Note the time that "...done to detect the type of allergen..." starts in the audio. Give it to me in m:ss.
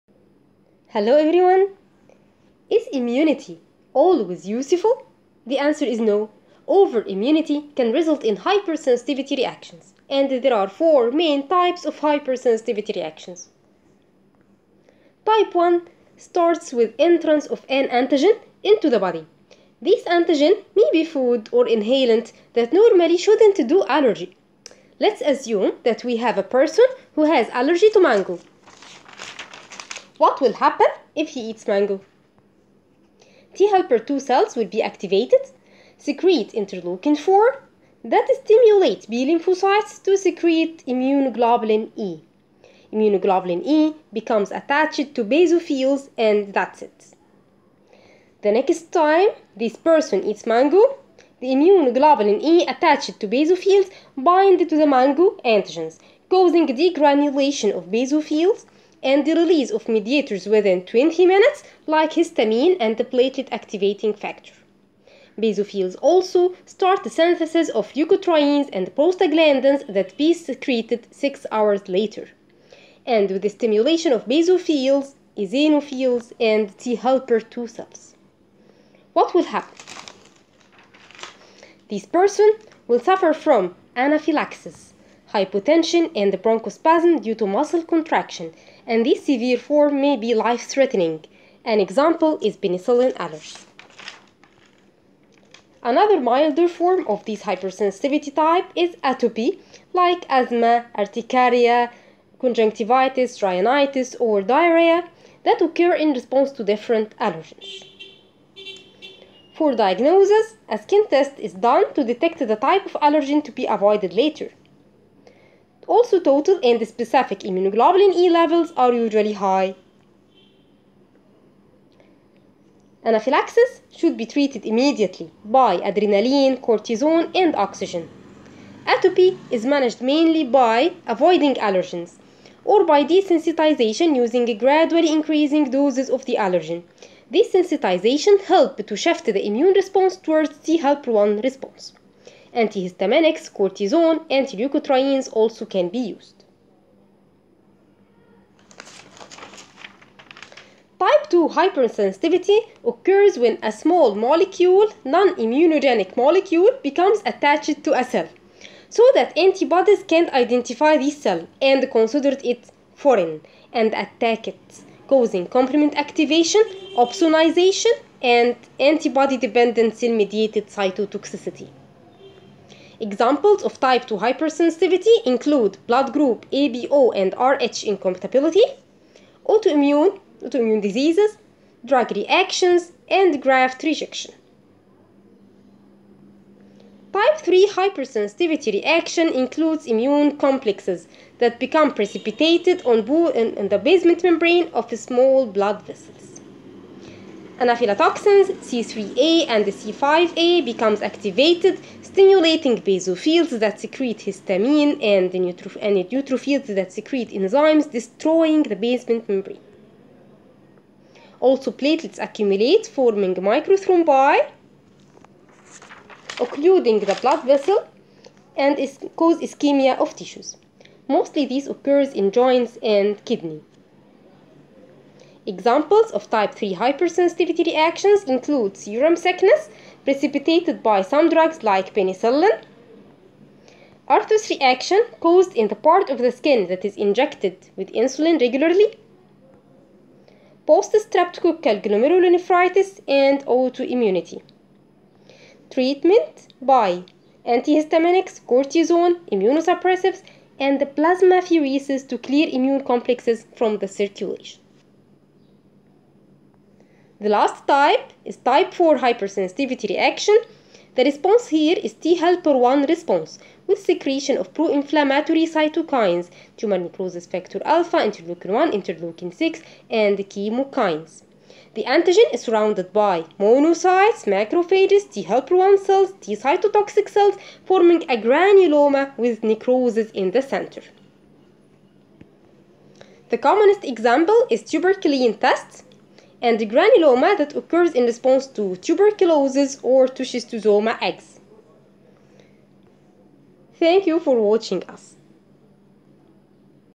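1:51.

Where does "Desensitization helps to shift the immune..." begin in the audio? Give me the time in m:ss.
2:17.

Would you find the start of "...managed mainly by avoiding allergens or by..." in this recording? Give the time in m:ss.
2:09.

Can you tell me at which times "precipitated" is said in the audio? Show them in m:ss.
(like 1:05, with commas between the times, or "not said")
3:11, 3:50.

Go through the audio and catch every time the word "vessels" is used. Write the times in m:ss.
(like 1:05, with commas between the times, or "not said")
3:15, 3:37.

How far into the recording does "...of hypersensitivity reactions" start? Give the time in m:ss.
0:11.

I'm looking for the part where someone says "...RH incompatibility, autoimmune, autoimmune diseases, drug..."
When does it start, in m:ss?
2:57.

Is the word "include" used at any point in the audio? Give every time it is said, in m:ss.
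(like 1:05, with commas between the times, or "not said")
2:55, 3:09, 3:48.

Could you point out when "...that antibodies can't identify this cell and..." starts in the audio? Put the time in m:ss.
2:39.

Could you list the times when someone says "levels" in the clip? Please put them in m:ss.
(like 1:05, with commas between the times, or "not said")
1:58.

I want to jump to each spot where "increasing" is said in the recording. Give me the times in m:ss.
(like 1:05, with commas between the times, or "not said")
2:15.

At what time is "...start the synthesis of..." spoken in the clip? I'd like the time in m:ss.
1:06.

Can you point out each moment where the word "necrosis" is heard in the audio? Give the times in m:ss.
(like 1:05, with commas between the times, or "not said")
4:26, 4:39.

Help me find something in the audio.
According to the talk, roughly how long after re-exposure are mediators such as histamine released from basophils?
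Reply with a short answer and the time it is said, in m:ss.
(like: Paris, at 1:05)
20 minutes, at 1:00.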